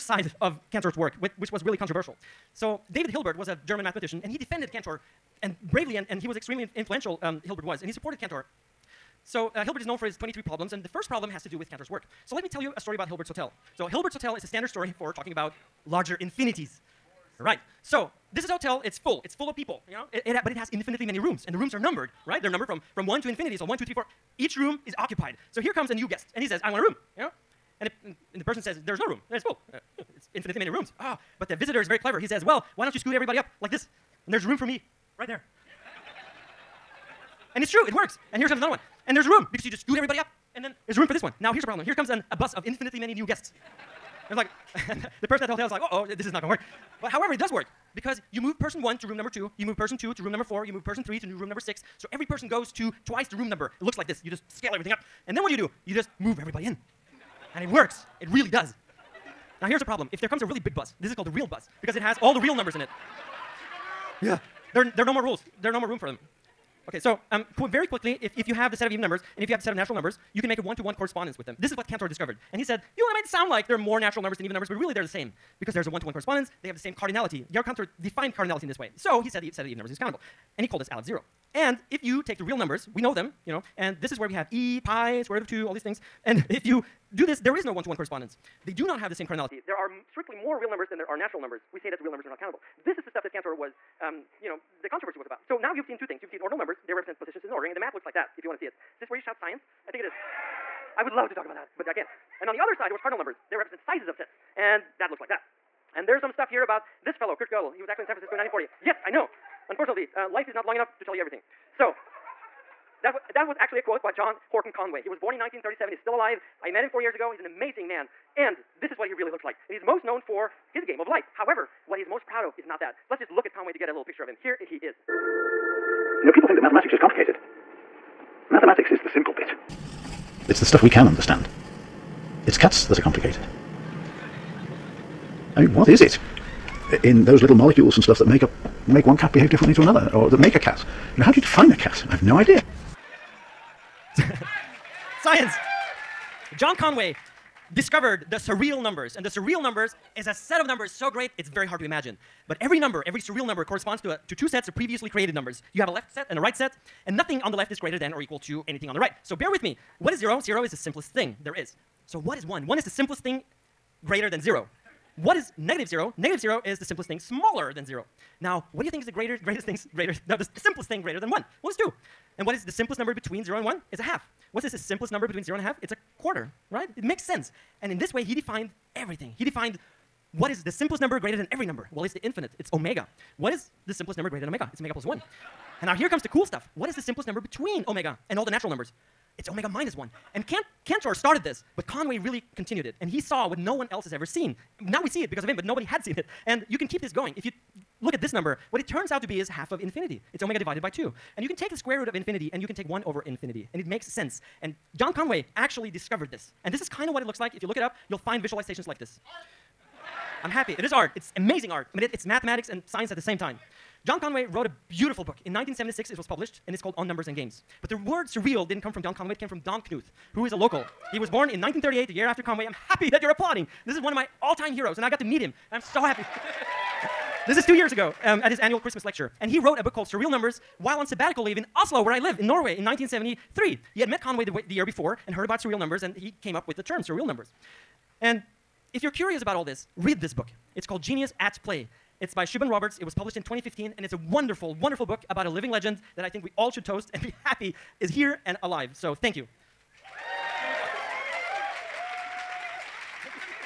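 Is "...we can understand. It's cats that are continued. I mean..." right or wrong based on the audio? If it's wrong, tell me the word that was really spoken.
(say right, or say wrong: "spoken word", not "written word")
wrong: "complicated", not "continued".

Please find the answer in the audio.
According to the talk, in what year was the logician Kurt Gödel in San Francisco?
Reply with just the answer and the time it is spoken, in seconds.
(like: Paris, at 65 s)
1940, at 108 s.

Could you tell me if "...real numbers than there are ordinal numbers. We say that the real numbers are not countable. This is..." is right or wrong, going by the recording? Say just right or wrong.
wrong.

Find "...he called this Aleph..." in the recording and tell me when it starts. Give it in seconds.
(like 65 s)
80 s.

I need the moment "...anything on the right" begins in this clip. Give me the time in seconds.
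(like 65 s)
158 s.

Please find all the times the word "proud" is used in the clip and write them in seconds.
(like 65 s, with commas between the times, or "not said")
122 s.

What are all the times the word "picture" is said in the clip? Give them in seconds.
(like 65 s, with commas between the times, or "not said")
124 s.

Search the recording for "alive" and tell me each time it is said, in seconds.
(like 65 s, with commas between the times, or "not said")
116 s, 248 s.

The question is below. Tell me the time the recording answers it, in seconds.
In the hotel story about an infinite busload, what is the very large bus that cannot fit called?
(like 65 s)
61 s.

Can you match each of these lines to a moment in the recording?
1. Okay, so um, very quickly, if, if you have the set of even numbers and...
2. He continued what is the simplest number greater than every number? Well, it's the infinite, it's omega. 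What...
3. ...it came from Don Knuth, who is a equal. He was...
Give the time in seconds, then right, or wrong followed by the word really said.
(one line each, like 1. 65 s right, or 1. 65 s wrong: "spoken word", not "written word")
1. 66 s right
2. 179 s wrong: "defined", not "continued"
3. 219 s wrong: "local", not "equal".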